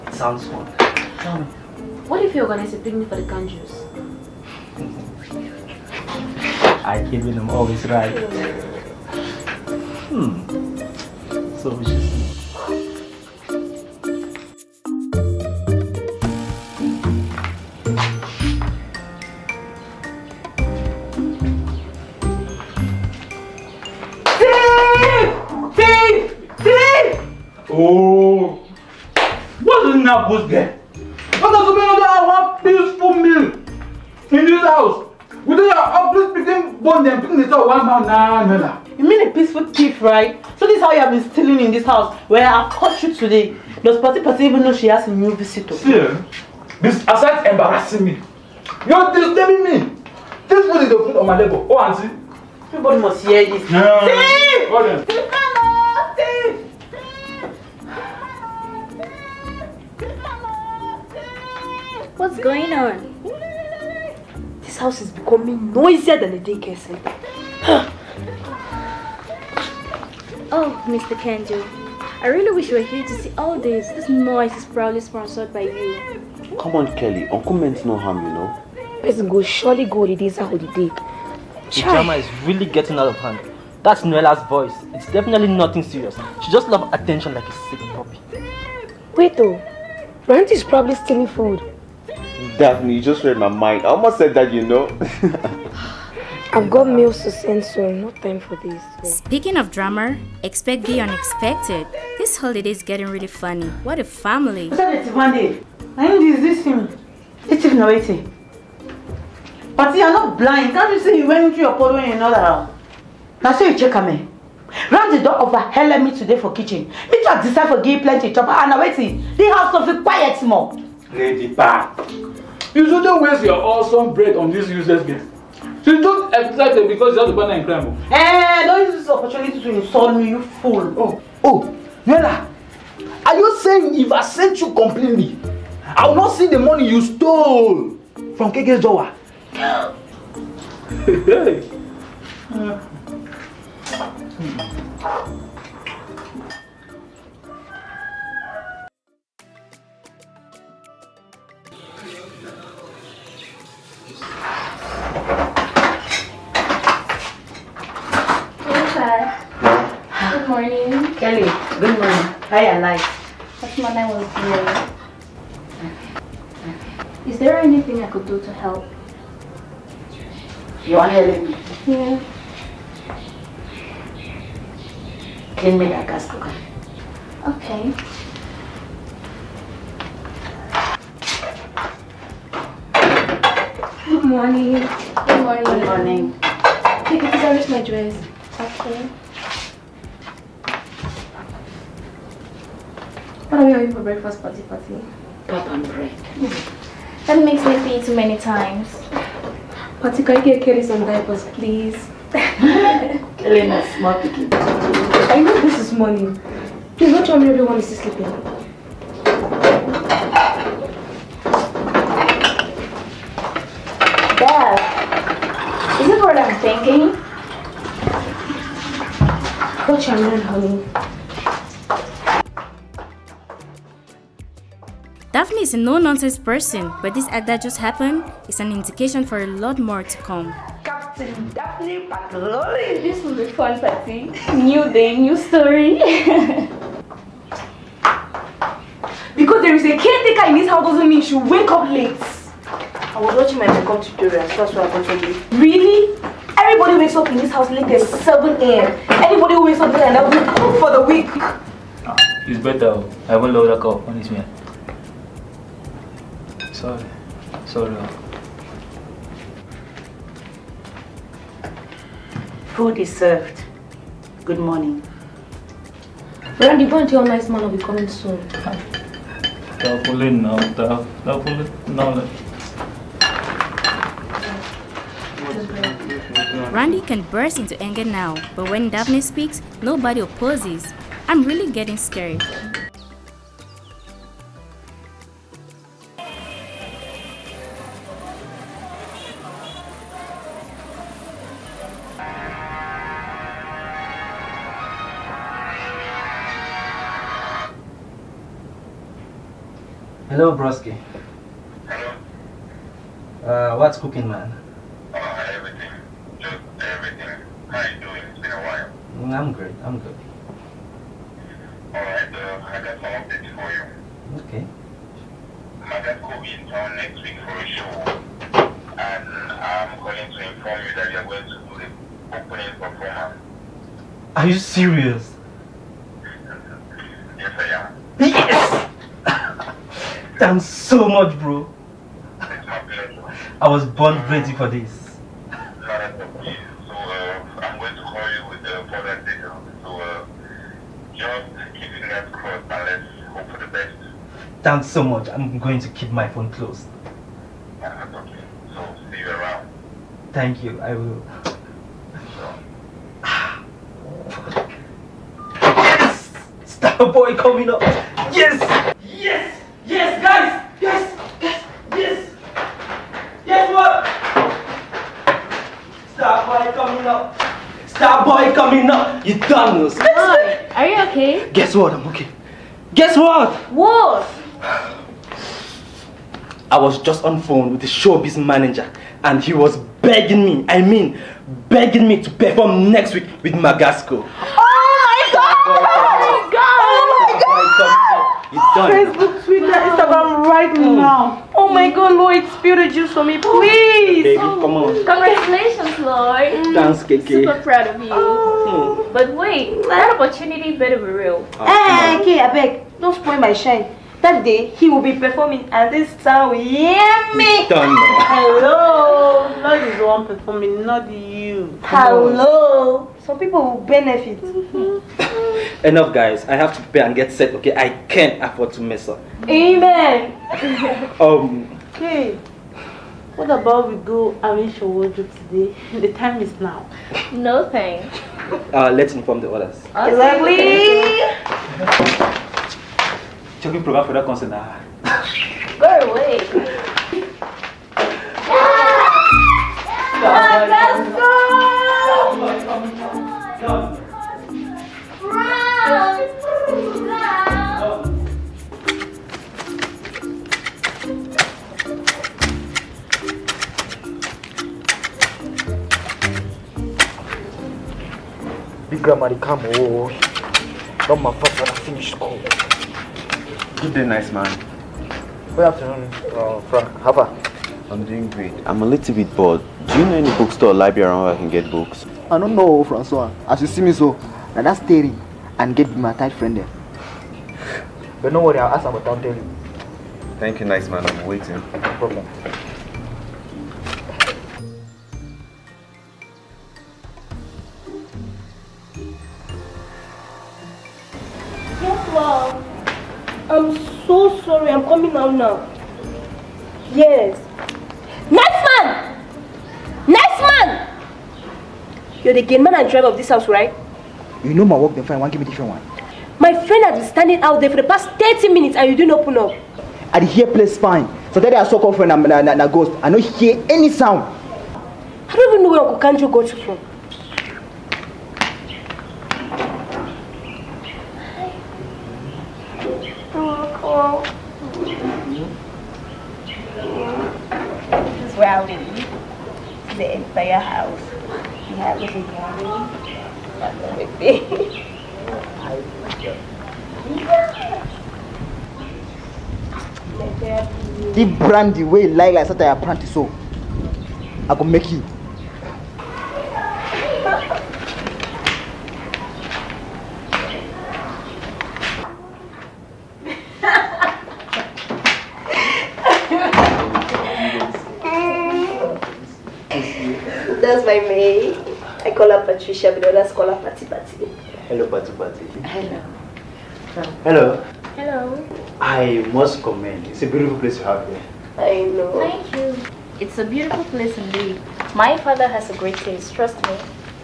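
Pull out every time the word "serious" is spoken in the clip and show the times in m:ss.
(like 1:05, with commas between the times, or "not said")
1:25, 5:24.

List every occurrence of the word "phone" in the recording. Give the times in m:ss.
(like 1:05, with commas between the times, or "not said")
5:46, 6:17.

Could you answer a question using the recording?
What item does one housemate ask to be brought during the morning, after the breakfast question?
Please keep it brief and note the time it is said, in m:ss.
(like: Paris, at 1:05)
diapers, at 3:21.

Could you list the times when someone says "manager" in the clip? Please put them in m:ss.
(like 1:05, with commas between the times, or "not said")
6:18.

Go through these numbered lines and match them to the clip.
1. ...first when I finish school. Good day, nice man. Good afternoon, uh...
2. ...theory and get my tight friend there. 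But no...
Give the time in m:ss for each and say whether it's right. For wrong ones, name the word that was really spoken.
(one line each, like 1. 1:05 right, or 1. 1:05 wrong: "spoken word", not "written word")
1. 7:41 right
2. 7:54 right.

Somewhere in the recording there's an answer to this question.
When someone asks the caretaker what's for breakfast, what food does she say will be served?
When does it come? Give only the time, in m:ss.
3:15.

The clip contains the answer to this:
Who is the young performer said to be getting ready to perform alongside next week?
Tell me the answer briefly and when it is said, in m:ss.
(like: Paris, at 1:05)
Magasco, at 6:23.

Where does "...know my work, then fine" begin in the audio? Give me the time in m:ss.
8:24.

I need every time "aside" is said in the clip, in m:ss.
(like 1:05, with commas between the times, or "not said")
0:47.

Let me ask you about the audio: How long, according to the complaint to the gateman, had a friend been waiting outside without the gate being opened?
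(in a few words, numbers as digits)
30 minutes.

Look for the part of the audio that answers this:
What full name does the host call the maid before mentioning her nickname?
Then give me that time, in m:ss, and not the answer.
9:22.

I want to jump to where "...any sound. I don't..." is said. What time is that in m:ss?
8:33.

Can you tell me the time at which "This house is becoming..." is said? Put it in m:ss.
1:04.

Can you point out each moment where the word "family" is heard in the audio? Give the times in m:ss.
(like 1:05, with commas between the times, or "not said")
1:44.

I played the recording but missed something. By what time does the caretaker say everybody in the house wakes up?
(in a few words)
7 a.m.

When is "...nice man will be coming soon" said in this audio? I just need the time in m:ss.
4:27.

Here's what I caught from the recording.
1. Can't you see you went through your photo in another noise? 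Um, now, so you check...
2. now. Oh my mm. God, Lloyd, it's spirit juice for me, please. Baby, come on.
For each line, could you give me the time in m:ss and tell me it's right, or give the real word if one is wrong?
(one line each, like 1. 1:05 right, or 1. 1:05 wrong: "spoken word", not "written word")
1. 1:50 wrong: "house", not "noise"
2. 6:30 right.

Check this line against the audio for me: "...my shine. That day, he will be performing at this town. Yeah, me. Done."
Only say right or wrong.
right.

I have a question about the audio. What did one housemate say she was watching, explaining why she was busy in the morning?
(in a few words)
makeup tutorial.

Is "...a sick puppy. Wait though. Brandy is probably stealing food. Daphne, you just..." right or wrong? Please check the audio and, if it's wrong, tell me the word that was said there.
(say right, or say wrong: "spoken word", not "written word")
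right.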